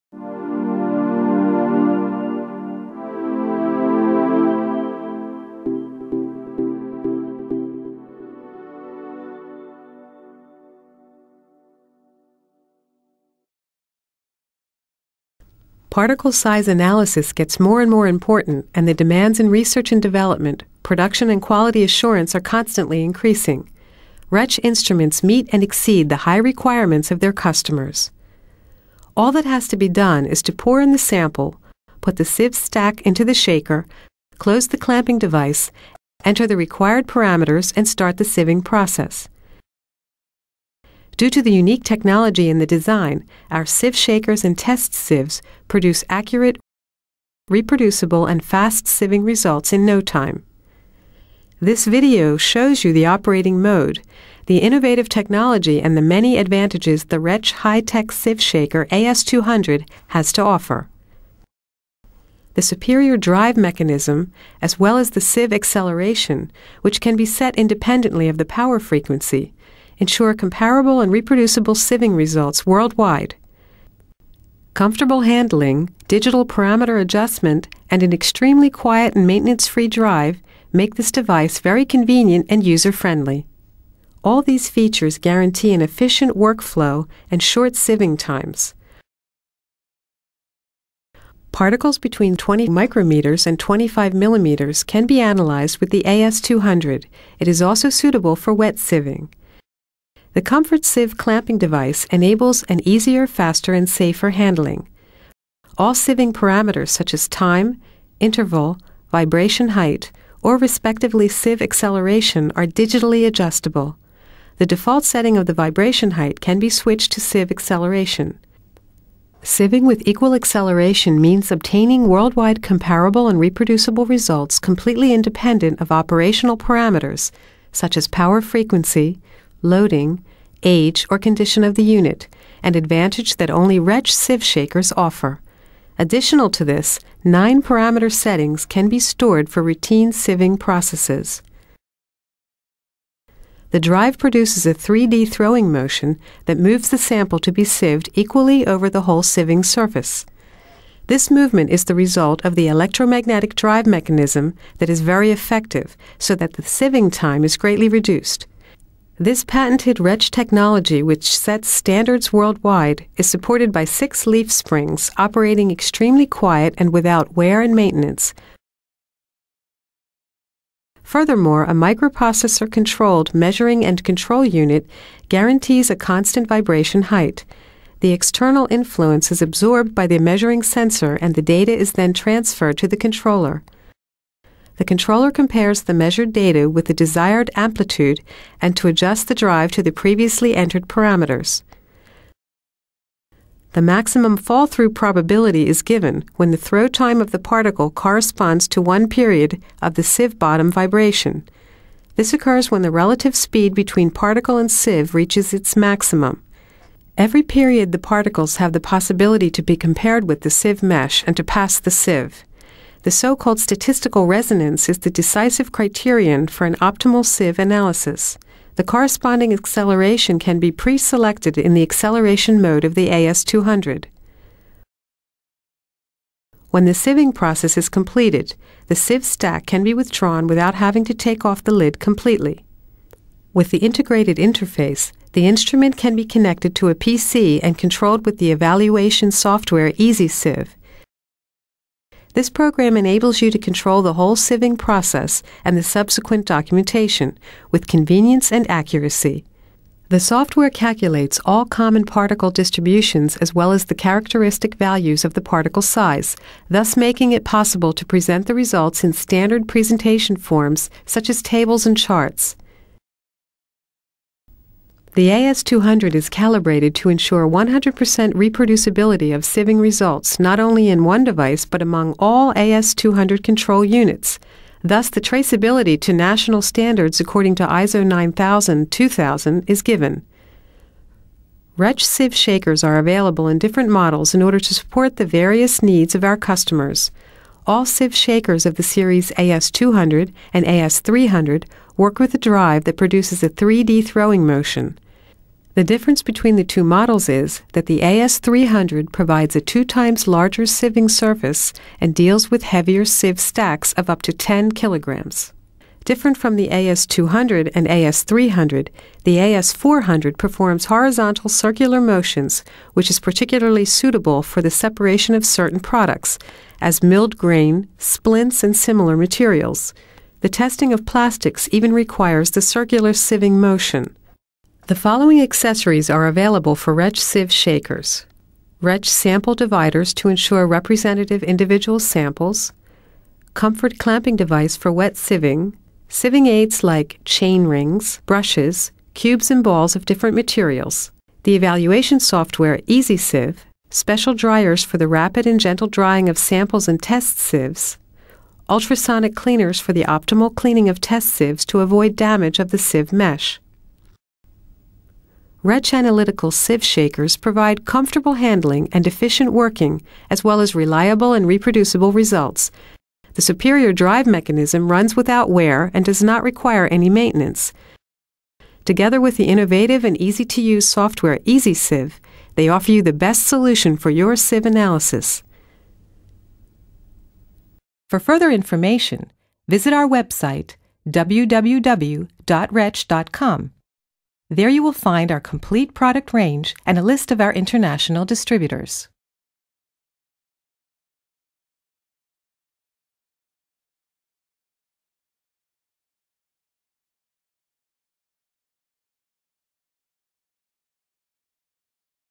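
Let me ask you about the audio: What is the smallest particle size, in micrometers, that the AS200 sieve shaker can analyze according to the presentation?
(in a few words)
20 micrometers.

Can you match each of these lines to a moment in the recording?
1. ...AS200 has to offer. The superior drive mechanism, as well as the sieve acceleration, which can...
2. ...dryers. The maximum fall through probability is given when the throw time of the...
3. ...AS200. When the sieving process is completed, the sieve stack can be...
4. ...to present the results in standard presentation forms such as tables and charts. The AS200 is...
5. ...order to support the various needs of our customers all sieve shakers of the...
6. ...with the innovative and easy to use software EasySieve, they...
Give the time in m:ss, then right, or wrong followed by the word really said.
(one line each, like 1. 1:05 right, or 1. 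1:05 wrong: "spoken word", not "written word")
1. 0:58 right
2. 3:10 wrong: "parameters", not "dryers"
3. 3:43 right
4. 4:17 right
5. 4:44 right
6. 6:09 right.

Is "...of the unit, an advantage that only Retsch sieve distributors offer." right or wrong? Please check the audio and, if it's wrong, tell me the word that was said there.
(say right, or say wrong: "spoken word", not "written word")
wrong: "shakers", not "distributors".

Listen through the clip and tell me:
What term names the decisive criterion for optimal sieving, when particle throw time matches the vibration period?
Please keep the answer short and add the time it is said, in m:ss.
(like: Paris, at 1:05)
Statistical resonance, at 3:33.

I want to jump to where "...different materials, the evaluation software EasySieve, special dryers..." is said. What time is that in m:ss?
5:40.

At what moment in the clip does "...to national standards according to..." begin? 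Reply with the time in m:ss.
4:35.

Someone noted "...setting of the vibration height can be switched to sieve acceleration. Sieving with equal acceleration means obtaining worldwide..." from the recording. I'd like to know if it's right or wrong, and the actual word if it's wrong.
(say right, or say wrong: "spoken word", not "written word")
right.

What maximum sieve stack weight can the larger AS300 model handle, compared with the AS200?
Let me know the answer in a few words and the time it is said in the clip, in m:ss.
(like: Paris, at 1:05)
10 kilograms, at 5:04.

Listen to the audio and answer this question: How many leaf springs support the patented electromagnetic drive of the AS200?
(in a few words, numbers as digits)
6.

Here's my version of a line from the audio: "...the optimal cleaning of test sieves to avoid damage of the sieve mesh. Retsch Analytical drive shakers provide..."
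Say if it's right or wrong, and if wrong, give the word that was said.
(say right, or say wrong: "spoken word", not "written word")
wrong: "sieve", not "drive".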